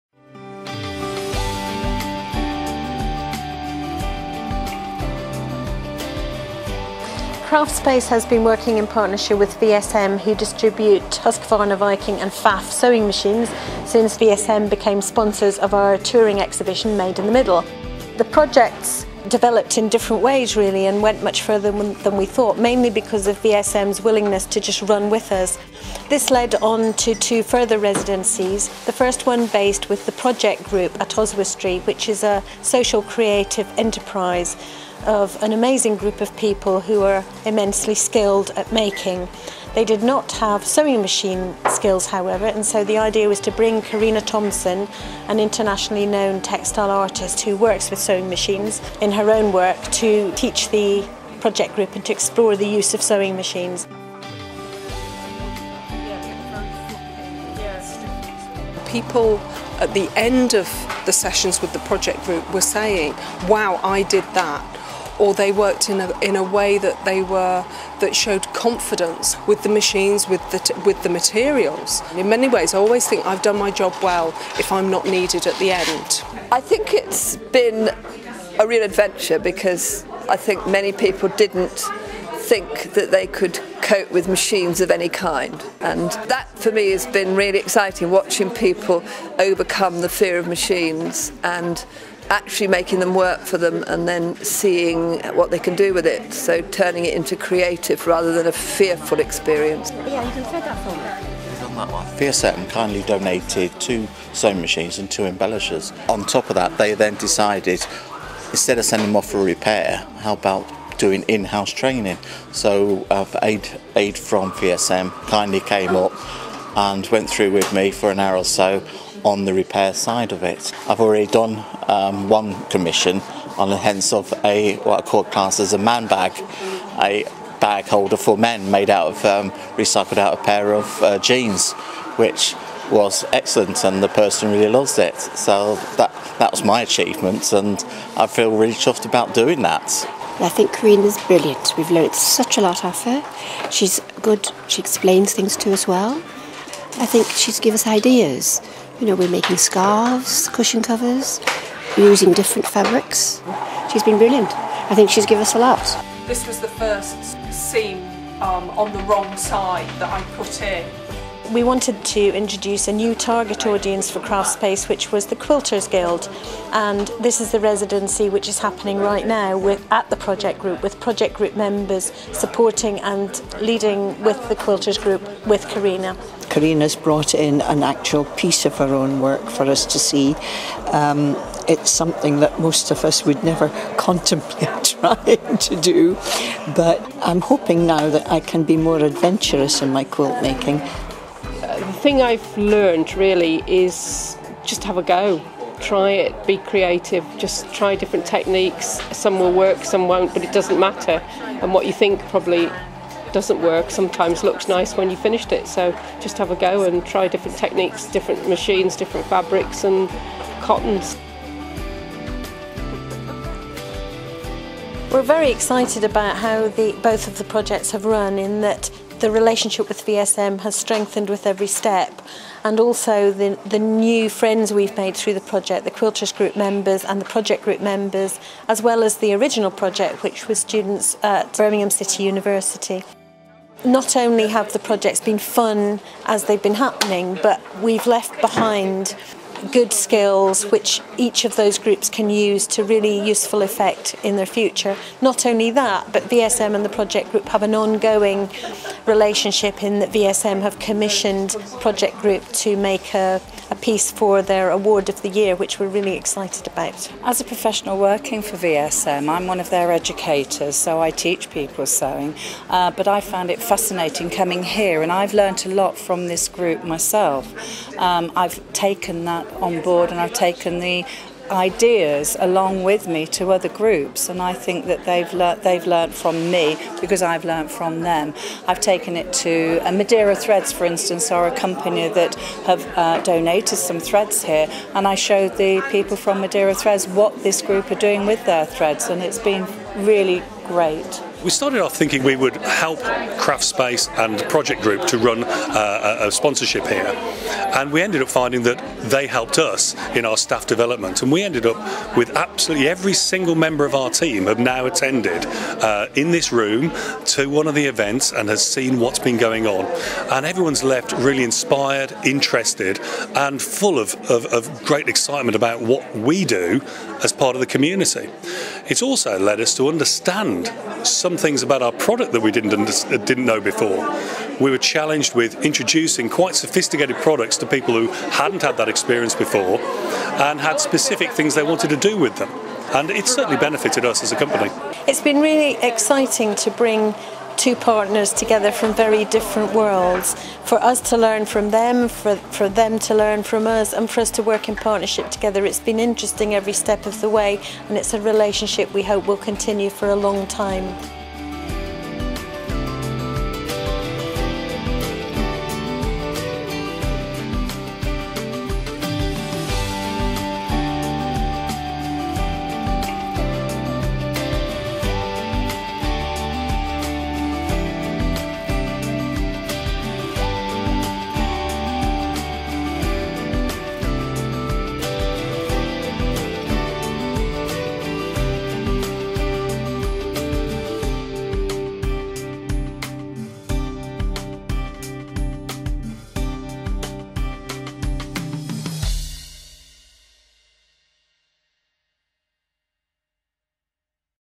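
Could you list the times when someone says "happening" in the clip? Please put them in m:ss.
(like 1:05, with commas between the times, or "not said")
2:48, 3:56.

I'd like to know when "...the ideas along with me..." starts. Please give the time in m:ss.
4:30.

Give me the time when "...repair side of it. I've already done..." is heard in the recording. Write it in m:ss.
1:59.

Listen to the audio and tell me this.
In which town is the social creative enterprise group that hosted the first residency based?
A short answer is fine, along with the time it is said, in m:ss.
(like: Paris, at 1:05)
Oswestry, at 0:31.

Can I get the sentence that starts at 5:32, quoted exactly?
And it's certainly benefited us as a company.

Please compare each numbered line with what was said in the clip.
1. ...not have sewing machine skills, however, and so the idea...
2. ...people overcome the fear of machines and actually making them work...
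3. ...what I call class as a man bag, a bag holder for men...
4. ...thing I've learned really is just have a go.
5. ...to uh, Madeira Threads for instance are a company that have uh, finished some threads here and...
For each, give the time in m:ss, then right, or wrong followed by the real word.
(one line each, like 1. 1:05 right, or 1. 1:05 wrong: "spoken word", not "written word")
1. 0:40 right
2. 1:28 right
3. 2:04 right
4. 3:12 right
5. 4:39 wrong: "donated", not "finished".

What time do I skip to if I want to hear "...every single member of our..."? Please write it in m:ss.
5:02.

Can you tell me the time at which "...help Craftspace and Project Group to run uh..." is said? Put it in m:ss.
4:52.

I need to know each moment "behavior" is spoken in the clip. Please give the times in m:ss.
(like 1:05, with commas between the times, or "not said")
not said.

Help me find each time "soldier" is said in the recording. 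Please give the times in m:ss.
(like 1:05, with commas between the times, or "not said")
not said.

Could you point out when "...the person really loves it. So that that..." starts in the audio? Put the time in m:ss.
2:14.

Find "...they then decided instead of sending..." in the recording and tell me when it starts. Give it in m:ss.
1:46.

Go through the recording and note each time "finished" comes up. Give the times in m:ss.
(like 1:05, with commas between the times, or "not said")
3:25.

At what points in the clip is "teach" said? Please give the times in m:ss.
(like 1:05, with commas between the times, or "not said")
0:50, 4:21.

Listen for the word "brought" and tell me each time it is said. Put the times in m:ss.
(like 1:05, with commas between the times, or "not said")
2:56.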